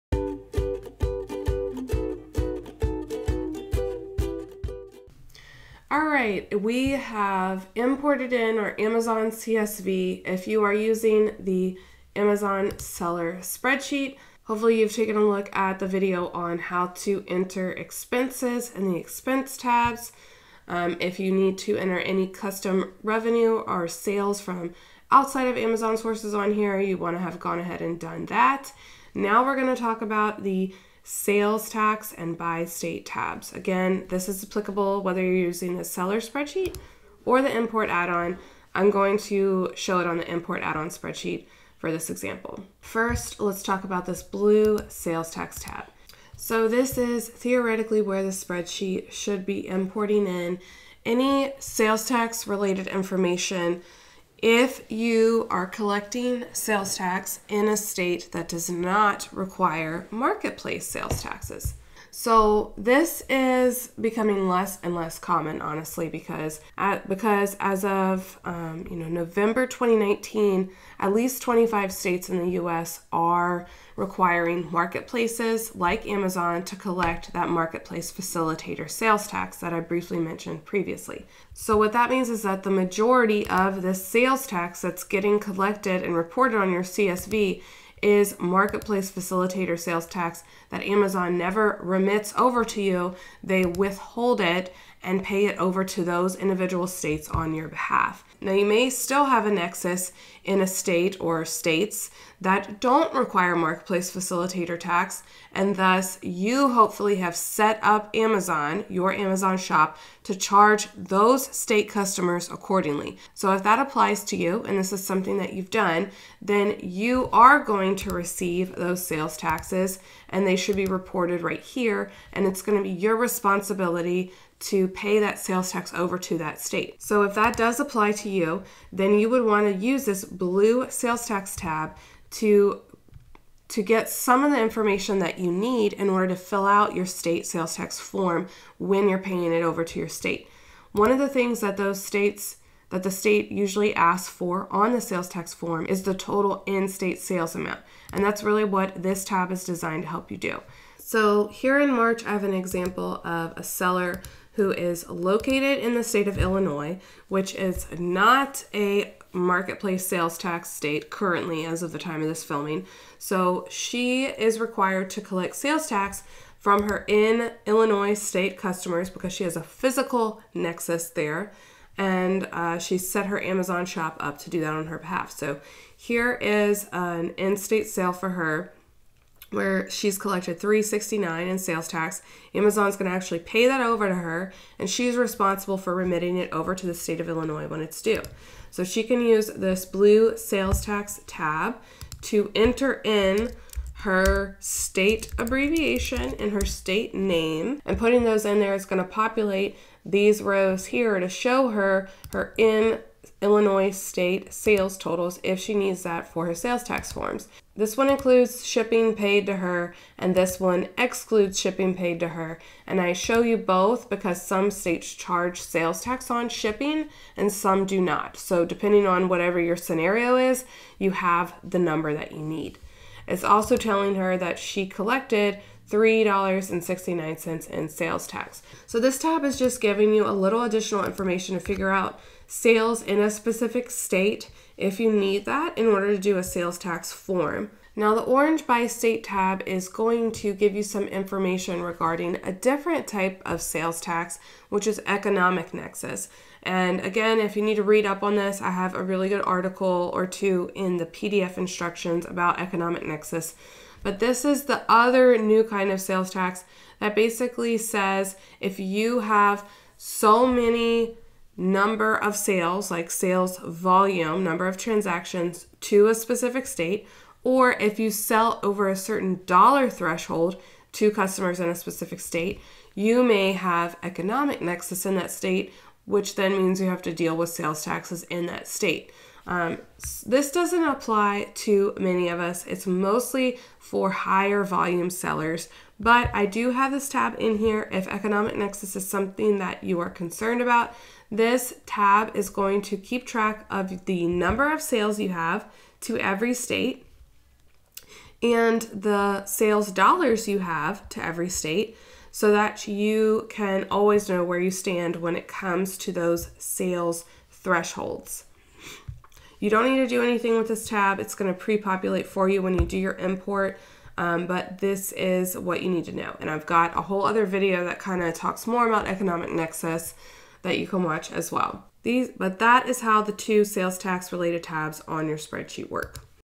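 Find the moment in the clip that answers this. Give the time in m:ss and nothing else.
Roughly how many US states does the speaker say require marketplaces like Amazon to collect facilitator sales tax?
1:11.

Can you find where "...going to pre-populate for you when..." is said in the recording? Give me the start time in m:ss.
5:11.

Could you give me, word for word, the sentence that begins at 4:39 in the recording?
Um, this doesn't apply to many of us.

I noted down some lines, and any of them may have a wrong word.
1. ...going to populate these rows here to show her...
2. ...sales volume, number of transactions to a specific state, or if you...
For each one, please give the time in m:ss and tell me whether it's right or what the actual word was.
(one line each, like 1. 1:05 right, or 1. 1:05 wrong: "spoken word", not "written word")
1. 3:18 right
2. 4:23 right.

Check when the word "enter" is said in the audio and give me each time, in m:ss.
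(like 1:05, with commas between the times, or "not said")
0:17, 0:21, 3:12.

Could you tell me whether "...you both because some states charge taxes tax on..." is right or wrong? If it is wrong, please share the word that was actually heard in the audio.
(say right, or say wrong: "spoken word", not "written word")
wrong: "sales", not "taxes".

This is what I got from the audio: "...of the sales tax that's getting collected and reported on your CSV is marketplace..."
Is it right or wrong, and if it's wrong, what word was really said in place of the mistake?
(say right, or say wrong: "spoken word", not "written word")
right.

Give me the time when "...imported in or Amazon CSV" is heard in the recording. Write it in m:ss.
0:07.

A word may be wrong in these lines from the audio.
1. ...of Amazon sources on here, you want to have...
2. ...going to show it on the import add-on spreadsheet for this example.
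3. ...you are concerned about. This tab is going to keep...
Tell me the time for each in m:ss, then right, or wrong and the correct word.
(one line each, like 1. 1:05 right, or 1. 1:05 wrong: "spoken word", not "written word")
1. 0:25 right
2. 0:38 right
3. 4:49 right.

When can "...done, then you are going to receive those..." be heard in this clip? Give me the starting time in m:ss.
1:55.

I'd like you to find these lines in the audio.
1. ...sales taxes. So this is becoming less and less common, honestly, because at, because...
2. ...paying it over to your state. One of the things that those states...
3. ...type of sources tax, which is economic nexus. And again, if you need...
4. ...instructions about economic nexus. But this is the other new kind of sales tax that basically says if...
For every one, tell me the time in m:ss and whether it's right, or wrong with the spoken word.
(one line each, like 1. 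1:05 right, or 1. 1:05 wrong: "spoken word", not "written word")
1. 1:00 right
2. 2:19 right
3. 4:03 wrong: "sales", not "sources"
4. 4:11 right.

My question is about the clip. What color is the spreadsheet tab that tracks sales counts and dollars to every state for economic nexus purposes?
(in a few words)
Orange.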